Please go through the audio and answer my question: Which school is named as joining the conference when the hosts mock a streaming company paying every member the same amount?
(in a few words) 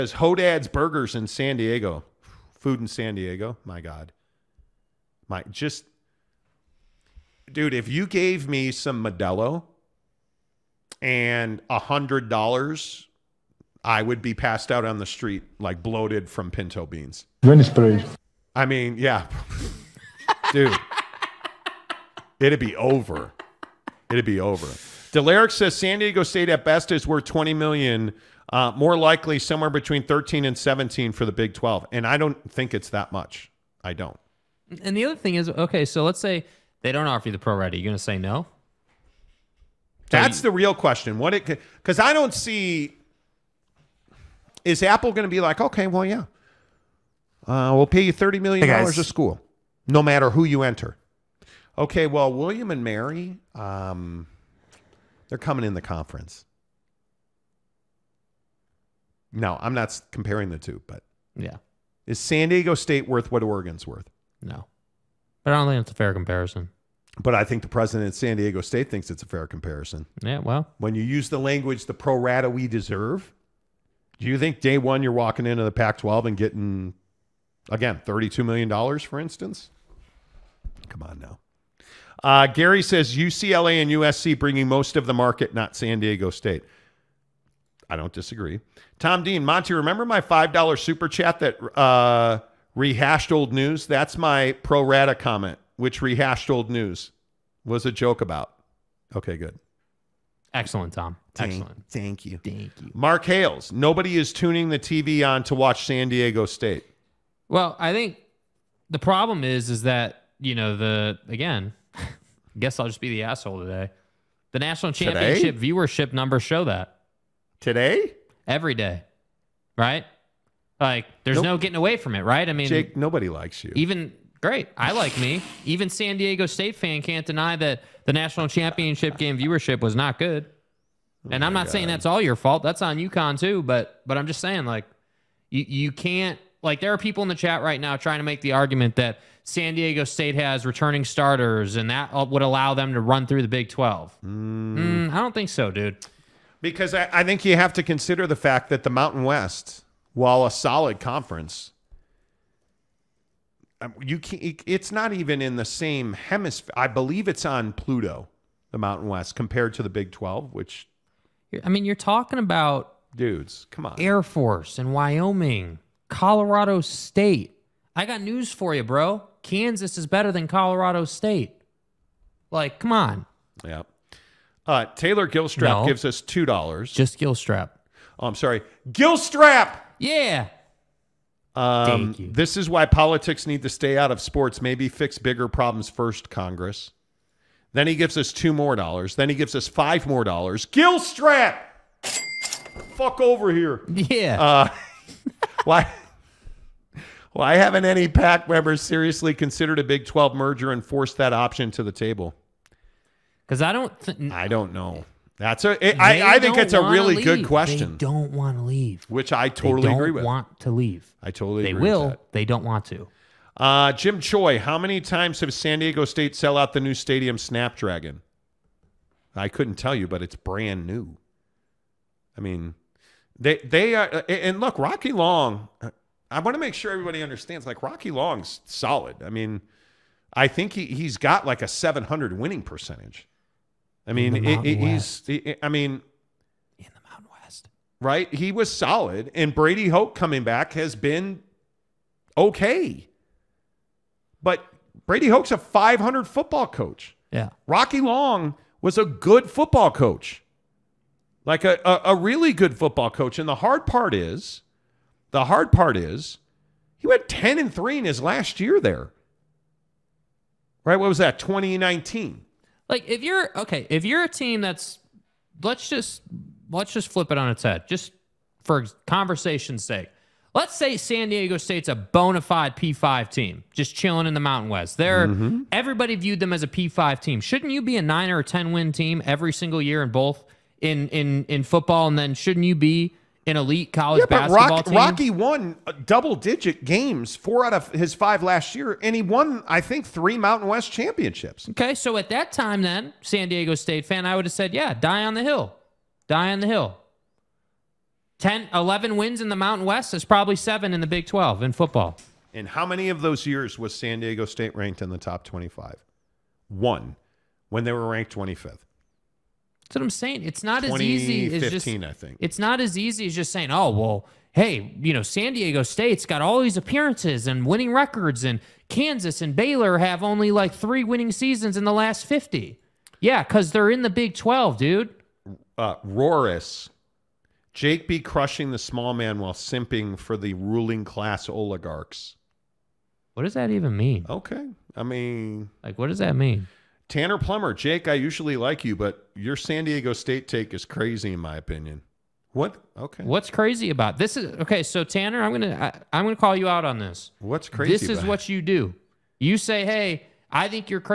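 William and Mary.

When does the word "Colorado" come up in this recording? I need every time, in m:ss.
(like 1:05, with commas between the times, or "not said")
2:46, 2:50.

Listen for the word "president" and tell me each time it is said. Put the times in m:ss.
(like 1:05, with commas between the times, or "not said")
1:07.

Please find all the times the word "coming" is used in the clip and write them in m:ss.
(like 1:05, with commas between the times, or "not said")
0:55, 4:00.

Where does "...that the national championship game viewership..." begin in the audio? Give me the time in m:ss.
2:07.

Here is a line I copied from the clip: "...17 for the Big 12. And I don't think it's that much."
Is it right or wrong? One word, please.
right.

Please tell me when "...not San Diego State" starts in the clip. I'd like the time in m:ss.
1:25.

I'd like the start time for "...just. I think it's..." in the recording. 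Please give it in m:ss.
5:11.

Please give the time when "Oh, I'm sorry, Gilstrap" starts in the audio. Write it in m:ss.
2:58.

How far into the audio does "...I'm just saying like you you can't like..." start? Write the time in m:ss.
2:14.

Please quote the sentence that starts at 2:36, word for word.
I believe it's on Pluto, the Mountain West, compared to the Big 12, which.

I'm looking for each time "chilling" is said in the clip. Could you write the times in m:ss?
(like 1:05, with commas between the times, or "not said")
4:33.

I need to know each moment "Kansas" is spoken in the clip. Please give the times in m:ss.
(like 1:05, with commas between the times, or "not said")
2:49, 5:18.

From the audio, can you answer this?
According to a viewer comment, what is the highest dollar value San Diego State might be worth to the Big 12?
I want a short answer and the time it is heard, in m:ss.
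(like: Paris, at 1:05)
20 million, at 0:27.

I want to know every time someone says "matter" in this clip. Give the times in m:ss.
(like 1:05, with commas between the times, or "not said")
0:50.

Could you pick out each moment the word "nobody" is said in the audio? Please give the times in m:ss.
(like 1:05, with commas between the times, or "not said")
1:43, 2:02.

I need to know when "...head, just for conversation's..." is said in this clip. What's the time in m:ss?
4:27.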